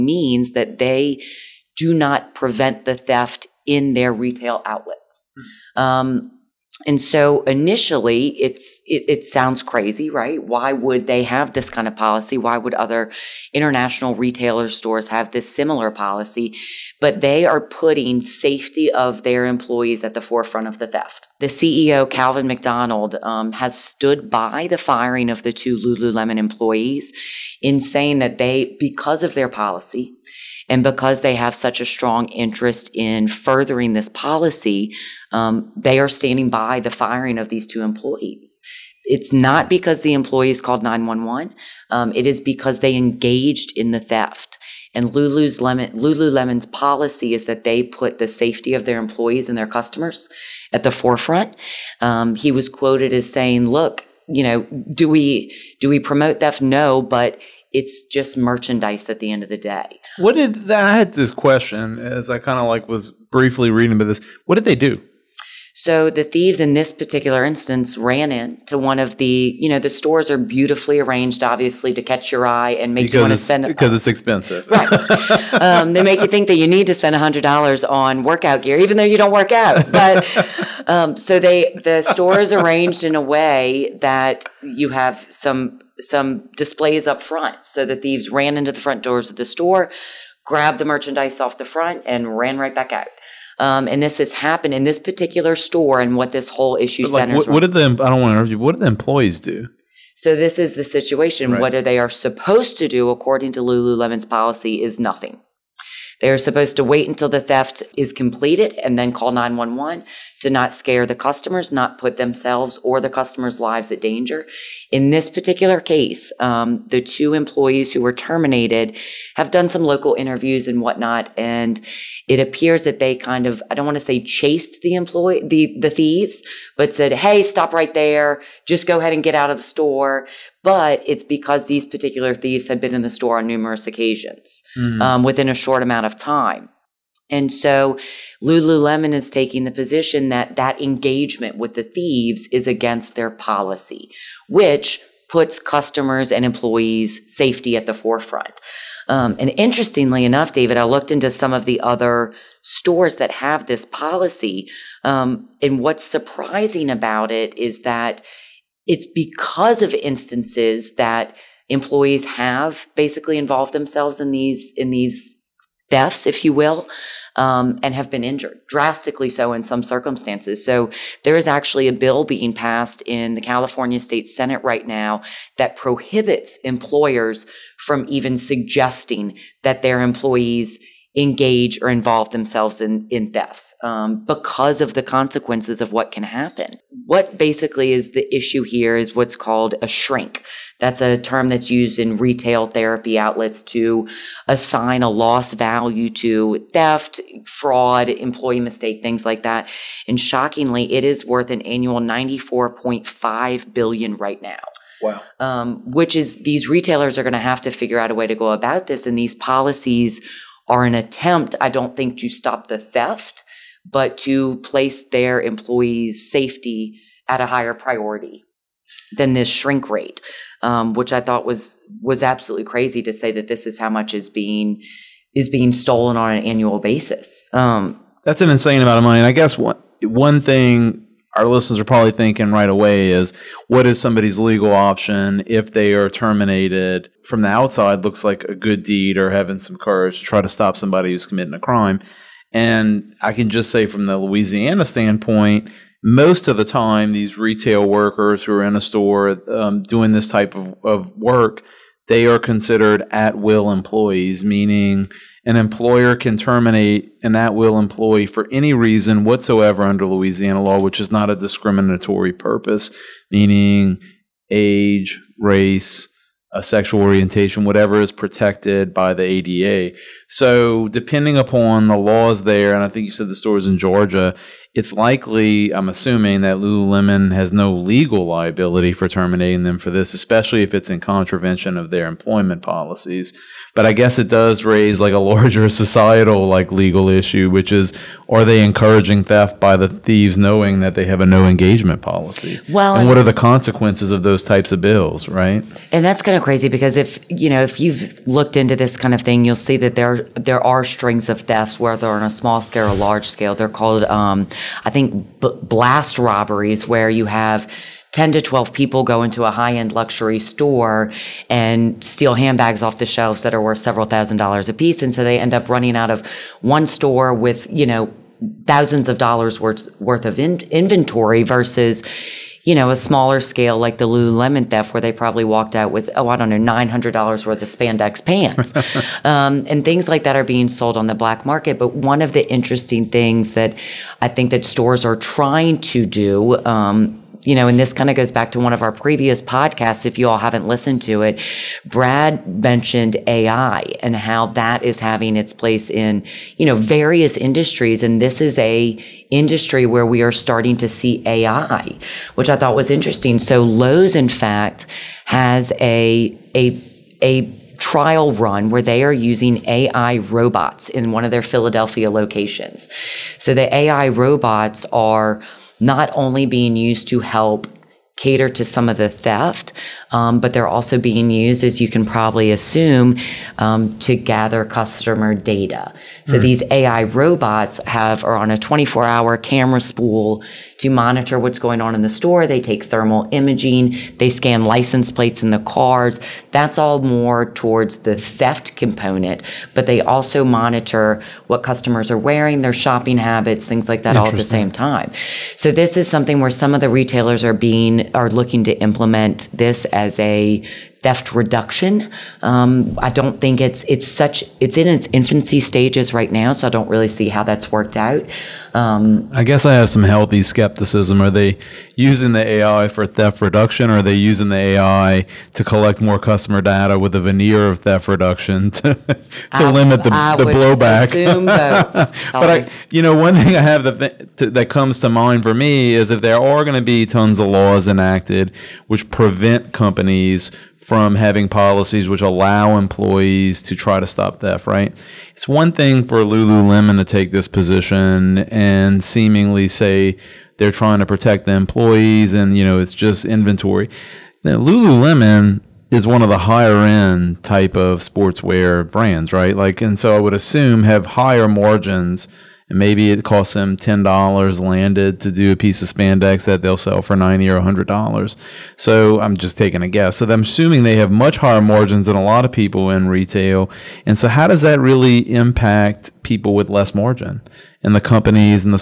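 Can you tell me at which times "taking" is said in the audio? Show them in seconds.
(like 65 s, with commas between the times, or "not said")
139 s, 459 s.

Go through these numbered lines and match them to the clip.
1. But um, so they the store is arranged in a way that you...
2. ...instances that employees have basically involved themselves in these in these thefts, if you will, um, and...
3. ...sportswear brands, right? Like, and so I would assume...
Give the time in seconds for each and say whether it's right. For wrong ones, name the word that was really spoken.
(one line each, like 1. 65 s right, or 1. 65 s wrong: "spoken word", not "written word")
1. 79 s right
2. 159 s right
3. 448 s right.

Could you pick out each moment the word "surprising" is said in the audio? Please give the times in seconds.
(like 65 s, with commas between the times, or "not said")
156 s.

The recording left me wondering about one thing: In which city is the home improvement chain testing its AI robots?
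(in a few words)
Philadelphia.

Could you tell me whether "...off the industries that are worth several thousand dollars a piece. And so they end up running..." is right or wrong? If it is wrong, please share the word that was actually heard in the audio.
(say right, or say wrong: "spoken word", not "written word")
wrong: "shelves", not "industries".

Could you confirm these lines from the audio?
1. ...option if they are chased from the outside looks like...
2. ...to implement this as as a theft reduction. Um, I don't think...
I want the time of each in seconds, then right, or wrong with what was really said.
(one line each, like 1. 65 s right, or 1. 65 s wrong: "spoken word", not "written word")
1. 234 s wrong: "terminated", not "chased"
2. 398 s right.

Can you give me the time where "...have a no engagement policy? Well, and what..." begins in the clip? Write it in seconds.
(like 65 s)
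291 s.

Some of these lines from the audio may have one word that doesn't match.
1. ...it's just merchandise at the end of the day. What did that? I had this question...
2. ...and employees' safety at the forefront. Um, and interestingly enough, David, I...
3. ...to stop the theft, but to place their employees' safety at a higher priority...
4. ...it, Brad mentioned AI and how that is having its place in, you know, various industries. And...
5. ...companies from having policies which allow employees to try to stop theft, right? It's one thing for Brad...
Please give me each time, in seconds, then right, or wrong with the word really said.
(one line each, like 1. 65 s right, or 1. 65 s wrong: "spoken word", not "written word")
1. 57 s right
2. 146 s right
3. 212 s right
4. 341 s right
5. 429 s wrong: "Lululemon", not "Brad".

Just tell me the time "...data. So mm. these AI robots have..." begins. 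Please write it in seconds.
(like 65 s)
375 s.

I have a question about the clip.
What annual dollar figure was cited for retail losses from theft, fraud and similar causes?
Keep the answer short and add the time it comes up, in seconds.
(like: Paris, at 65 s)
94.5 billion, at 201 s.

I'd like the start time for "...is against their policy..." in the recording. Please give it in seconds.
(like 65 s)
142 s.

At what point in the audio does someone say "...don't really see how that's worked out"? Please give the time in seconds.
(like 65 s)
406 s.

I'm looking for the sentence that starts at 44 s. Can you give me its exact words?
And Lulu's Lemon, Lululemon's policy is that they put the safety of their employees and their customers at the forefront.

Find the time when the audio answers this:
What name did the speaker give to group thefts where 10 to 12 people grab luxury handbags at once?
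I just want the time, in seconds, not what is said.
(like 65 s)
305 s.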